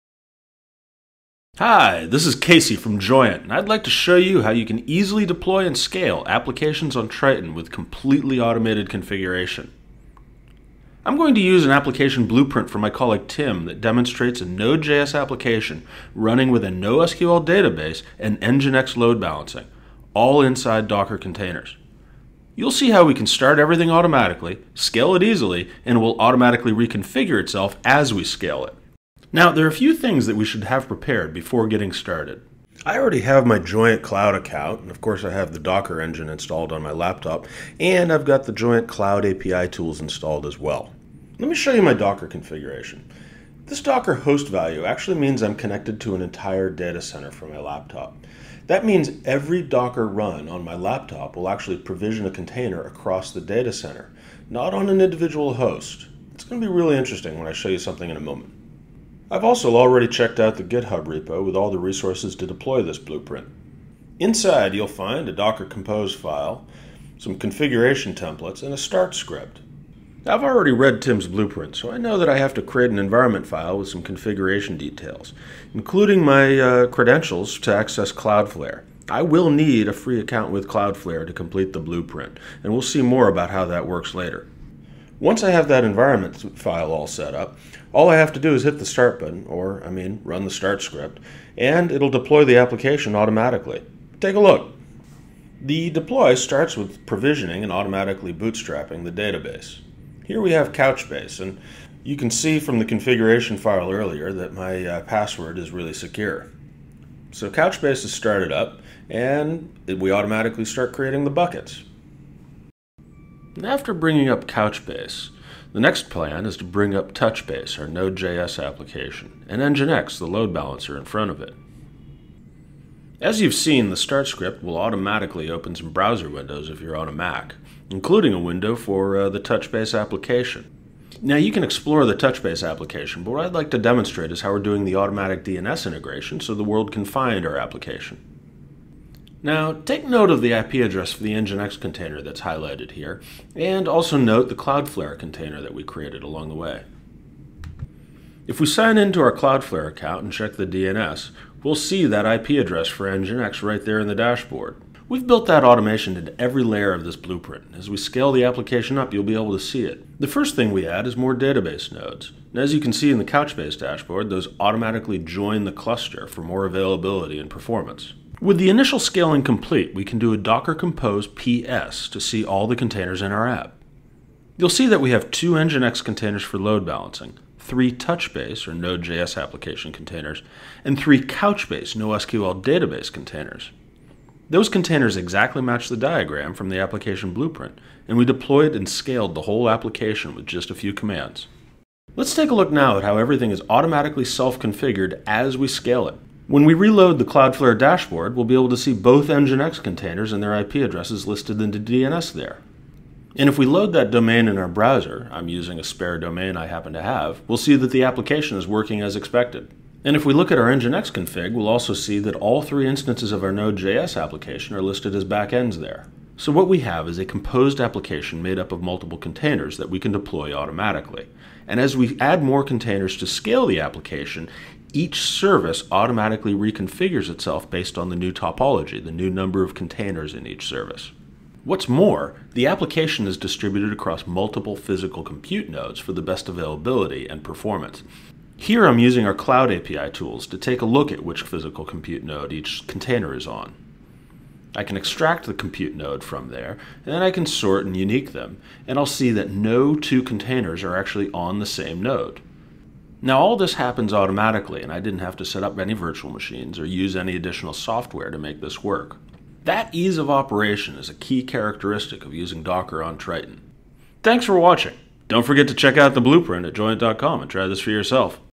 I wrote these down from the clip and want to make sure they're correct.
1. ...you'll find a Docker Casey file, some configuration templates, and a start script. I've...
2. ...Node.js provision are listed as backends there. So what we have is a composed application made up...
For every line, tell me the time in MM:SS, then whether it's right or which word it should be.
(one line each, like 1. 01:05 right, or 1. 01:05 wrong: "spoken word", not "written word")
1. 01:04 wrong: "Compose", not "Casey"
2. 03:33 wrong: "application", not "provision".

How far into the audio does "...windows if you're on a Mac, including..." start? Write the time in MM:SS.
02:06.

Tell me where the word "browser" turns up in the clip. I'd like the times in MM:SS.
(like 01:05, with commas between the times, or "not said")
02:05, 03:24.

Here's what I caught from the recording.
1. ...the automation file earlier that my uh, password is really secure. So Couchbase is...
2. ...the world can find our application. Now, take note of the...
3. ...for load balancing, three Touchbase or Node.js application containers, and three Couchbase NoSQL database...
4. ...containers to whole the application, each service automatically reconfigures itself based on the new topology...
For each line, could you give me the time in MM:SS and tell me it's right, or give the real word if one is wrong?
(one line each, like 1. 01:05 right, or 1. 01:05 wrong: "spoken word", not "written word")
1. 01:42 wrong: "configuration", not "automation"
2. 02:16 right
3. 02:56 right
4. 03:42 wrong: "scale", not "whole".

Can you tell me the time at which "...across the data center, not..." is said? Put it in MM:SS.
00:52.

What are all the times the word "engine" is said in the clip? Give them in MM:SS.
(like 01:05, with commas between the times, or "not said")
00:36.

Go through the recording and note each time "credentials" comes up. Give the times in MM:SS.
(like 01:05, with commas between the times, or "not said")
01:16.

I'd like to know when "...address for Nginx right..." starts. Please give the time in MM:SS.
02:32.